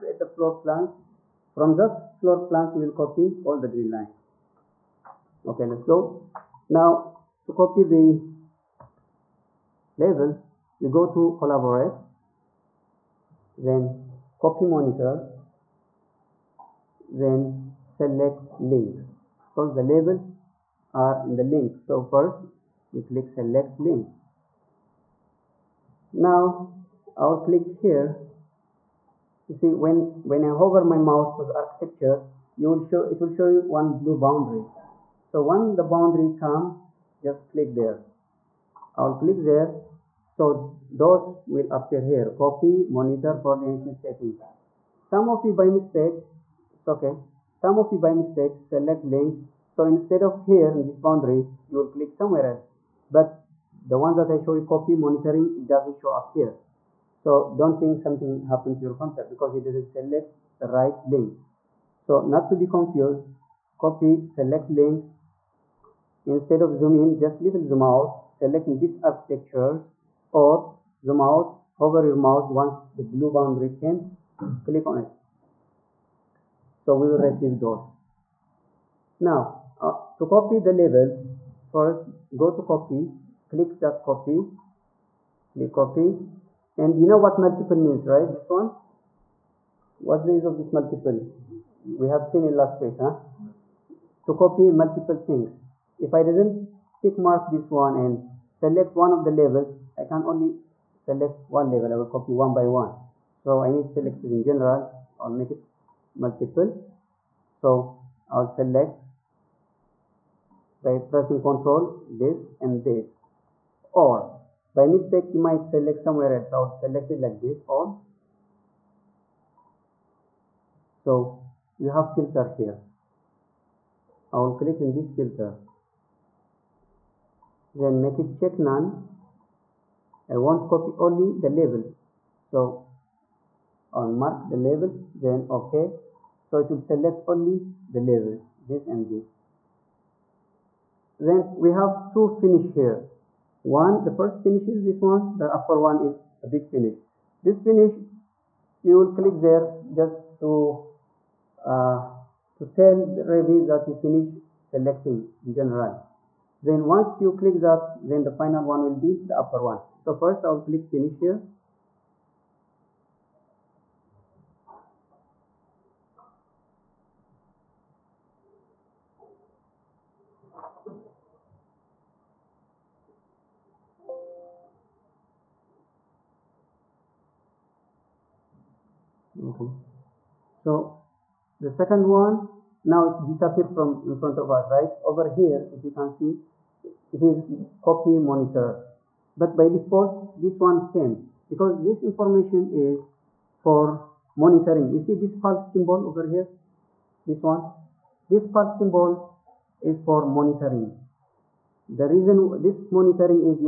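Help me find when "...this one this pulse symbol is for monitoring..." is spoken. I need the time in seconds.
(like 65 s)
197 s.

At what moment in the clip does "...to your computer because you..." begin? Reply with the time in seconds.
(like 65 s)
58 s.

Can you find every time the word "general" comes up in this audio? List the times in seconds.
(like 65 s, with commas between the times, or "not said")
104 s, 155 s.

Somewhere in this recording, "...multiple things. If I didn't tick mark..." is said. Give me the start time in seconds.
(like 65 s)
94 s.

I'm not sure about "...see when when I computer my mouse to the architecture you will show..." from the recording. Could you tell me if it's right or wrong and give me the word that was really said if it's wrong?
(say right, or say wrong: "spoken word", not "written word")
wrong: "hover", not "computer".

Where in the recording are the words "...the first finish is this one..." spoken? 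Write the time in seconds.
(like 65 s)
144 s.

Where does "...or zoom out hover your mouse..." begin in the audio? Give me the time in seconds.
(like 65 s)
70 s.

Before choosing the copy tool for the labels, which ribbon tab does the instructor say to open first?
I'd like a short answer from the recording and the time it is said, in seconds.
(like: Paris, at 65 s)
Collaborate, at 11 s.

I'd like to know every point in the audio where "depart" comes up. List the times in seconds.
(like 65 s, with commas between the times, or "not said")
not said.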